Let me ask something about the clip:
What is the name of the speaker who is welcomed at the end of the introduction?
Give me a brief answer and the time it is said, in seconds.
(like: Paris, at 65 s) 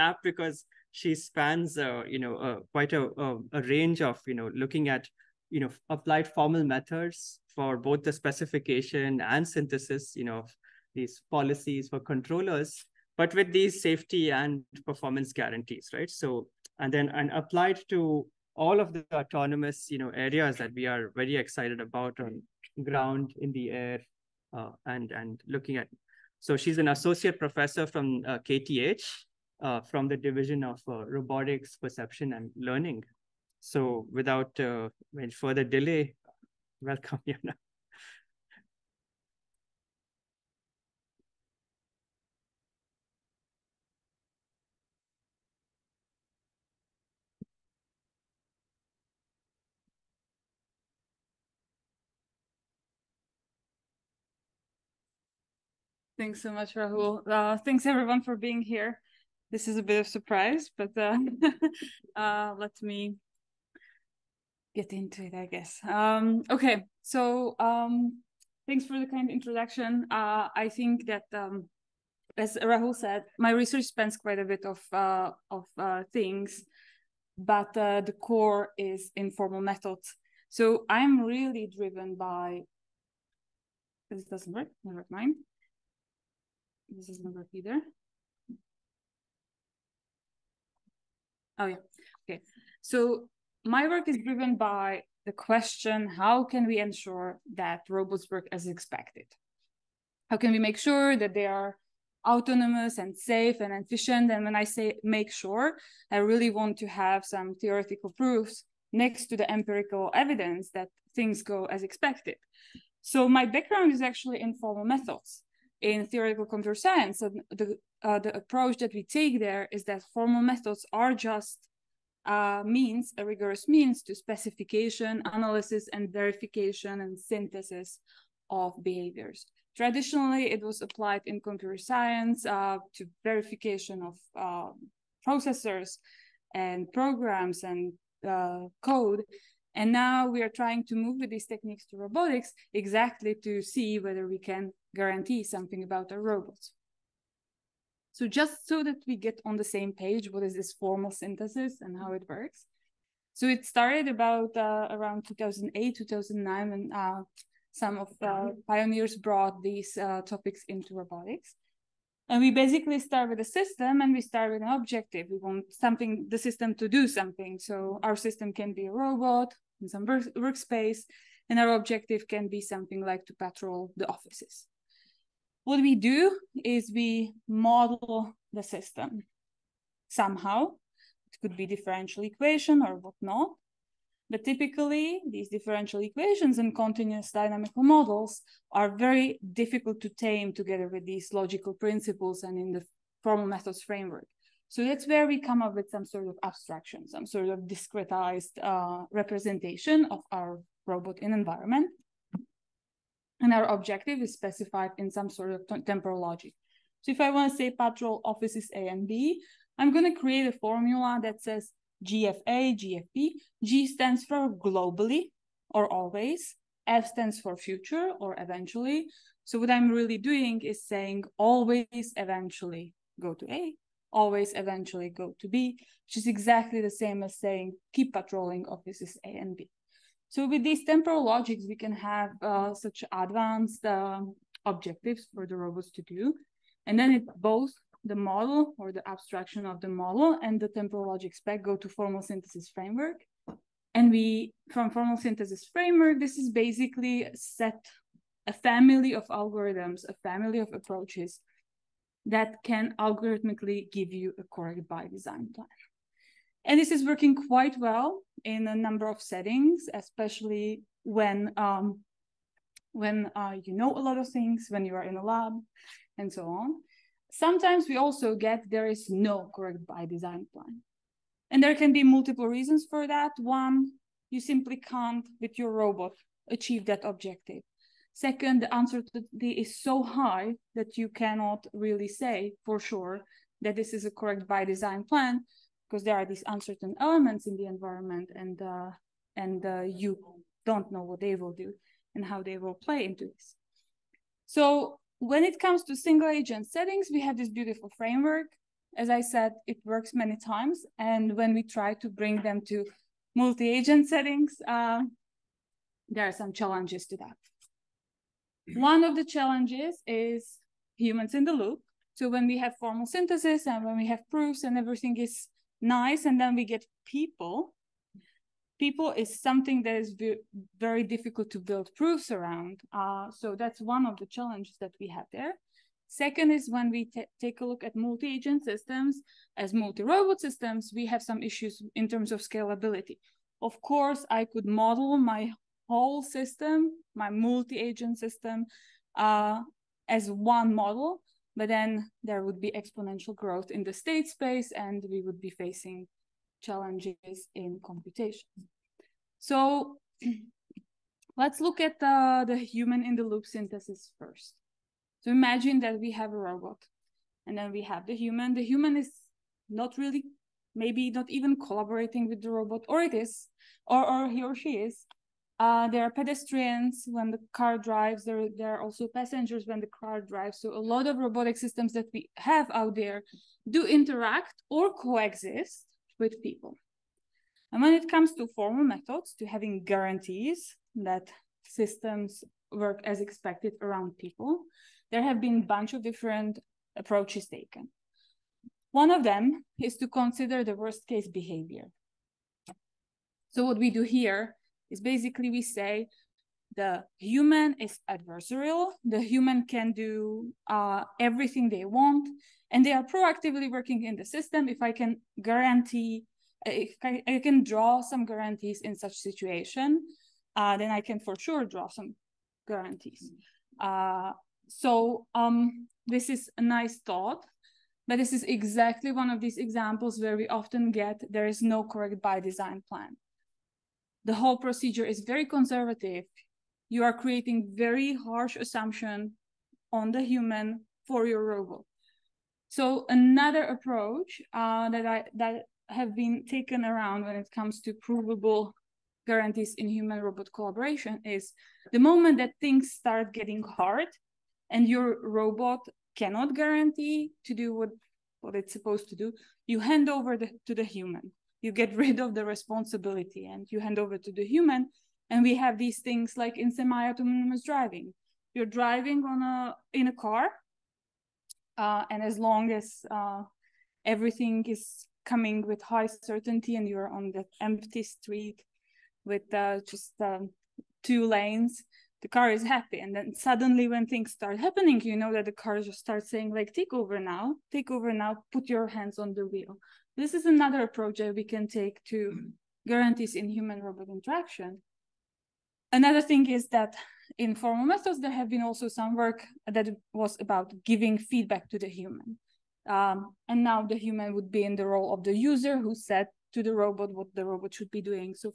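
Jana, at 37 s.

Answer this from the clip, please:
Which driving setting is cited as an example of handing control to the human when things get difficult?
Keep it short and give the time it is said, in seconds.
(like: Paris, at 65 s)
semi-autonomous driving, at 456 s.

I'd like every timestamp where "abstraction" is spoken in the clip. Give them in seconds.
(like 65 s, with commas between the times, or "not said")
196 s, 239 s.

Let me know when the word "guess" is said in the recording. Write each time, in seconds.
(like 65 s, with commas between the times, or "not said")
65 s.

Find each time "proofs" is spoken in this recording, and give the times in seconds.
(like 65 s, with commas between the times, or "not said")
108 s, 314 s, 321 s.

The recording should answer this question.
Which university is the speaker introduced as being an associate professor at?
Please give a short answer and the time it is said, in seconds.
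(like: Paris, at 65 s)
KTH, at 28 s.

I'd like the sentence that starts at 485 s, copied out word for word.
Another thing is that in formal methods, there have been also some work that was about giving feedback to the human.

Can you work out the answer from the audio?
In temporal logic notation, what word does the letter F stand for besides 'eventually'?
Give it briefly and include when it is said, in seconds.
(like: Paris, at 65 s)
future, at 217 s.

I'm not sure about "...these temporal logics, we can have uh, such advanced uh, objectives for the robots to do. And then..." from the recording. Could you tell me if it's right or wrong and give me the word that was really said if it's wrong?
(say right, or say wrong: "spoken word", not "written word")
right.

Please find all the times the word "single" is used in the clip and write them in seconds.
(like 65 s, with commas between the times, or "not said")
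295 s.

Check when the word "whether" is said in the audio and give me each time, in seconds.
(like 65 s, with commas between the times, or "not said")
143 s.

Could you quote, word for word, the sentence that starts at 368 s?
There, there are also passengers when the car drives.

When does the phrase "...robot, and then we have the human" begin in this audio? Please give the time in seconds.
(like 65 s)
356 s.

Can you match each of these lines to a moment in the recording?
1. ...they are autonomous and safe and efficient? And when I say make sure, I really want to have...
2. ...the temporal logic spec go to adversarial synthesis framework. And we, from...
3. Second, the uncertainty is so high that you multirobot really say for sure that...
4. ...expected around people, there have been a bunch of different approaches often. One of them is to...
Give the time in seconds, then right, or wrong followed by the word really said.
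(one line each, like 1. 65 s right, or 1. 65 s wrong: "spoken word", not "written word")
1. 101 s right
2. 240 s wrong: "formal", not "adversarial"
3. 278 s wrong: "cannot", not "multirobot"
4. 383 s wrong: "taken", not "often".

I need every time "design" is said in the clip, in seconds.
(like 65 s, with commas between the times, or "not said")
255 s, 270 s, 284 s, 422 s.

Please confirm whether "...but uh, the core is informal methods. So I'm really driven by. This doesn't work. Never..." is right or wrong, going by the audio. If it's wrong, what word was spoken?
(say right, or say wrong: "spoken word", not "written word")
right.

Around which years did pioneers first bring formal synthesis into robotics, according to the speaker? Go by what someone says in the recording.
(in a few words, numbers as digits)
2008, 2009.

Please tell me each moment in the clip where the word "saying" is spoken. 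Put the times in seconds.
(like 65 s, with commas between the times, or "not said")
220 s, 227 s, 476 s.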